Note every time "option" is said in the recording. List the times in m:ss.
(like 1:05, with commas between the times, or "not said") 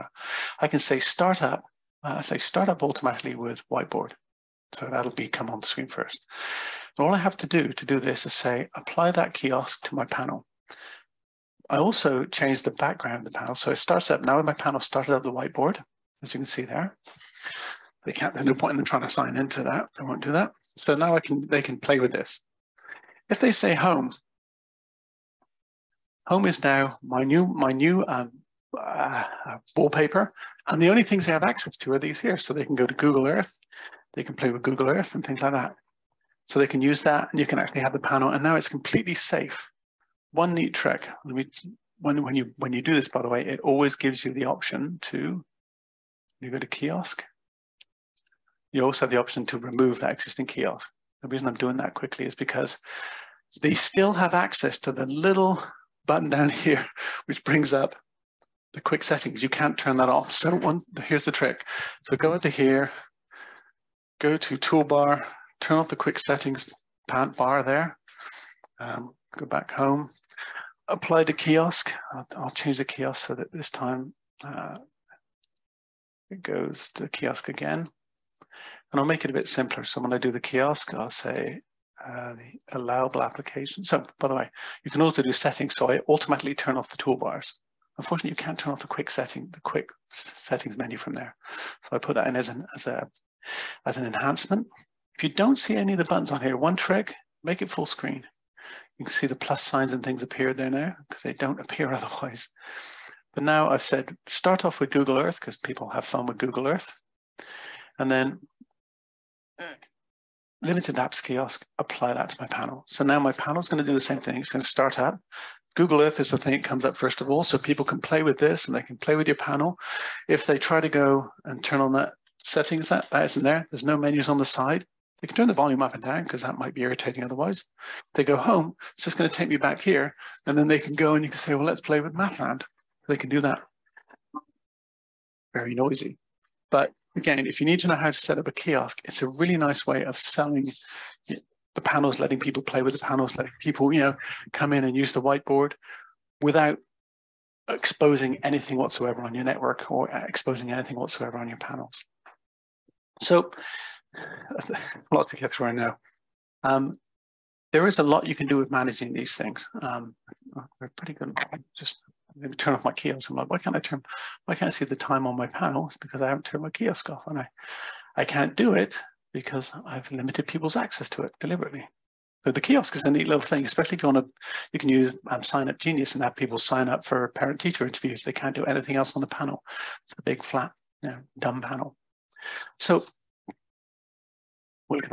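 0:44, 0:49.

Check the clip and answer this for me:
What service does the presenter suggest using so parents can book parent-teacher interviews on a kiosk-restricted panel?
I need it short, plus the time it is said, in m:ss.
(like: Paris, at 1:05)
Sign Up Genius, at 2:55.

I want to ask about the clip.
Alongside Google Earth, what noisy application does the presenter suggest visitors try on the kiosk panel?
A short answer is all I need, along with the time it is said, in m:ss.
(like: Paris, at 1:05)
Mathland, at 2:12.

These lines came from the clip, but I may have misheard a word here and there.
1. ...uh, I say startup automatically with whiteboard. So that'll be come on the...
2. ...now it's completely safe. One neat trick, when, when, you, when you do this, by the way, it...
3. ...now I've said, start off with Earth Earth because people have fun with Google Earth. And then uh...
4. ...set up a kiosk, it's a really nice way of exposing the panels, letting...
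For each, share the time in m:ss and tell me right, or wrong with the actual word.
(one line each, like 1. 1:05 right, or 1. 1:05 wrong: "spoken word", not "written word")
1. 0:02 right
2. 0:38 right
3. 1:43 wrong: "Google", not "Earth"
4. 2:18 wrong: "selling", not "exposing".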